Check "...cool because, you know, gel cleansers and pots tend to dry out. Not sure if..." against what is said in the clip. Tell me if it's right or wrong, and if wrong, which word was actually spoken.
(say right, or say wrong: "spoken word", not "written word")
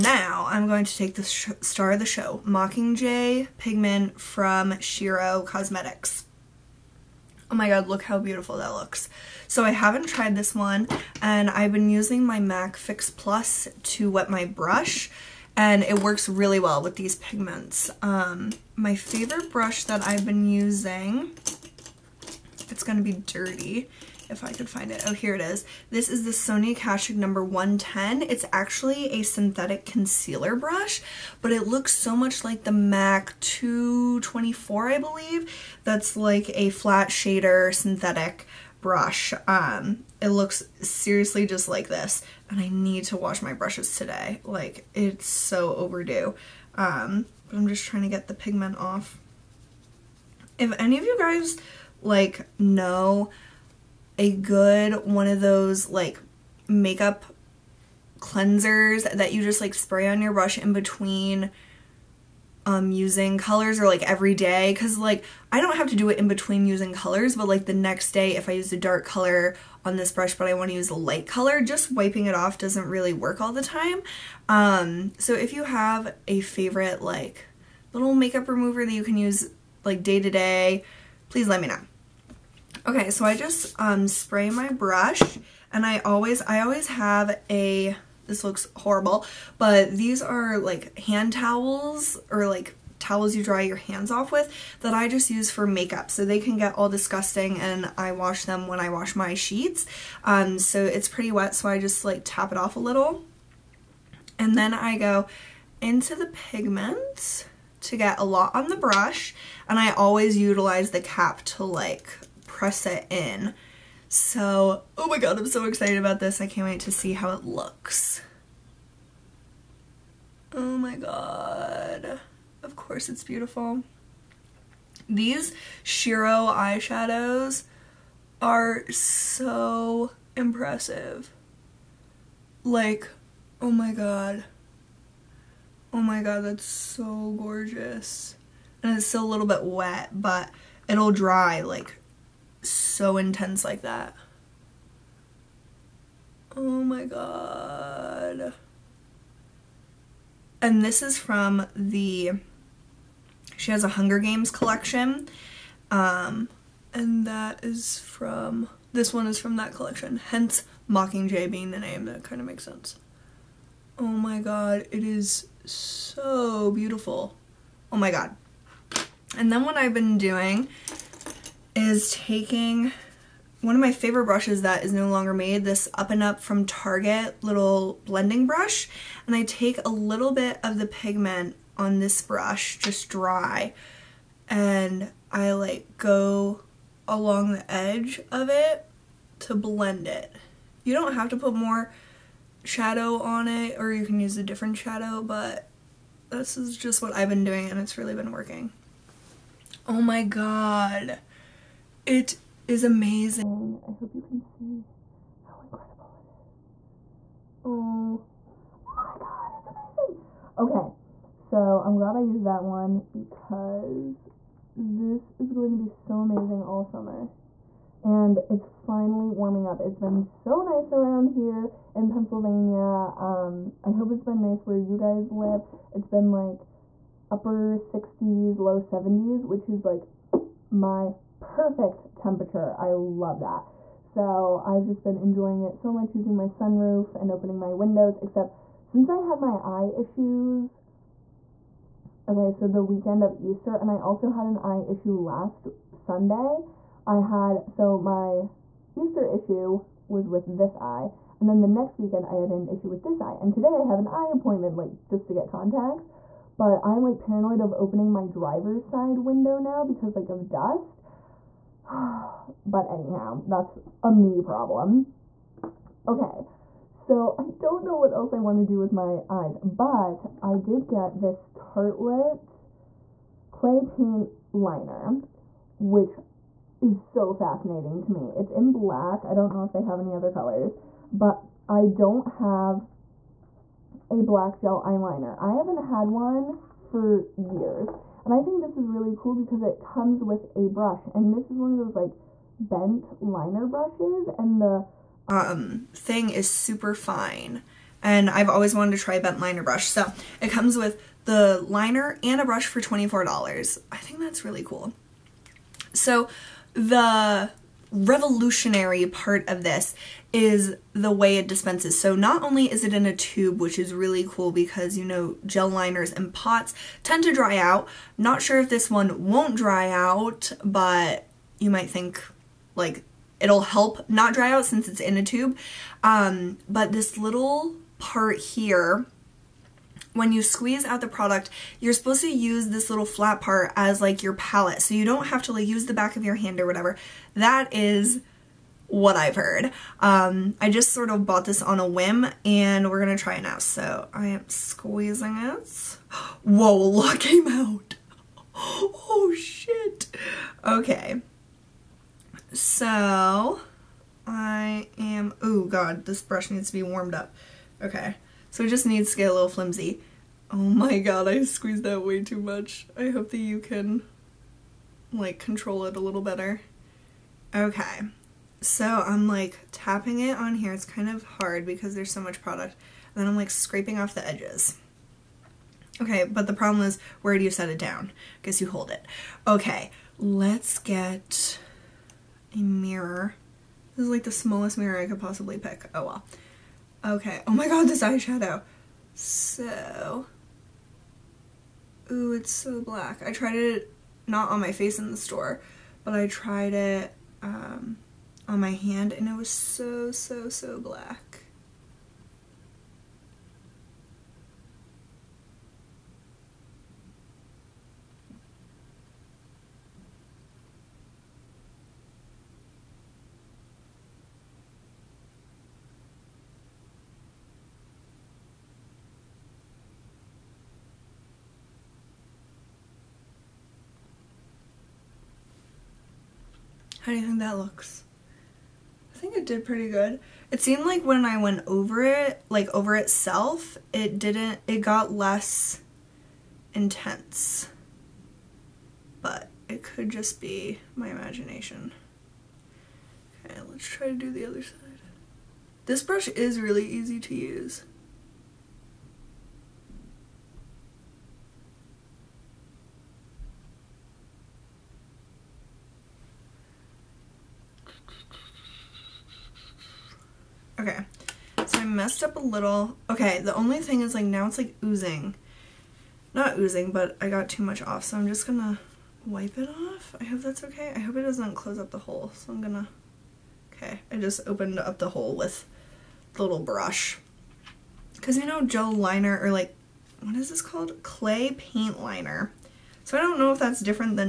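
wrong: "liners", not "cleansers".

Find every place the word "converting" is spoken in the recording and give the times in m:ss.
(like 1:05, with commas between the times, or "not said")
not said.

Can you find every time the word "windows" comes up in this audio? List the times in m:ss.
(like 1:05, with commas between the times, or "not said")
3:57, 4:19.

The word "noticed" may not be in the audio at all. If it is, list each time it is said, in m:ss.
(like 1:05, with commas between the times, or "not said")
not said.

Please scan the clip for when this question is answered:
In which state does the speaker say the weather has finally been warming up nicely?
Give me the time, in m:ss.
3:42.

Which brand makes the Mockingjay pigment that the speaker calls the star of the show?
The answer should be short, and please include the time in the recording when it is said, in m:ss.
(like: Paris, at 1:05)
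Shiro Cosmetics, at 0:04.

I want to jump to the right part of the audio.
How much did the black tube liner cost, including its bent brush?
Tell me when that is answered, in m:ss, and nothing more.
5:02.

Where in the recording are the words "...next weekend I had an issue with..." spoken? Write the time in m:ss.
4:11.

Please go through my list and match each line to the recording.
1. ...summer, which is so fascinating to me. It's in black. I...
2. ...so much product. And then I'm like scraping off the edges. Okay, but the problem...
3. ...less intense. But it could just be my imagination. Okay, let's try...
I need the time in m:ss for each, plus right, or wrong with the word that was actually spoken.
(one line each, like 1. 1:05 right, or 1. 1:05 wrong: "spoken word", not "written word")
1. 4:34 wrong: "liner", not "summer"
2. 6:12 right
3. 7:15 right.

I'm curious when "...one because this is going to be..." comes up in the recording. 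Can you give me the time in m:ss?
3:32.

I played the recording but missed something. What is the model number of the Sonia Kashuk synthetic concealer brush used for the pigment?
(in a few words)
110.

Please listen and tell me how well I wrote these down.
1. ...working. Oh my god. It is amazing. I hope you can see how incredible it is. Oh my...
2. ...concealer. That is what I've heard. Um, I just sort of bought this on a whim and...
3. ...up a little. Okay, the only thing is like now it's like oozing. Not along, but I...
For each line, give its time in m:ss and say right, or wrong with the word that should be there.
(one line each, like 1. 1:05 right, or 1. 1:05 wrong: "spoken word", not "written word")
1. 3:18 right
2. 5:36 wrong: "whatever", not "concealer"
3. 7:42 wrong: "oozing", not "along".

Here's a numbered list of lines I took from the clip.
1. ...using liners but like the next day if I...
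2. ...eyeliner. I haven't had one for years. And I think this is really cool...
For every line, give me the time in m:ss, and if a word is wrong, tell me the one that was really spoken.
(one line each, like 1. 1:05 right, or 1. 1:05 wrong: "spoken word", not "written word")
1. 1:06 wrong: "colors", not "liners"
2. 4:44 right.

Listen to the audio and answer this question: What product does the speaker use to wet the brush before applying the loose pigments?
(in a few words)
MAC Fix Plus.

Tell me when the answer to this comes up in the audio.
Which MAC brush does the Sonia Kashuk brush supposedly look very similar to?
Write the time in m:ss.
0:32.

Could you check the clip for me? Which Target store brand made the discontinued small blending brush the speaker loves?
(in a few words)
Up and Up.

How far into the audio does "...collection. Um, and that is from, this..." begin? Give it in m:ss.
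2:34.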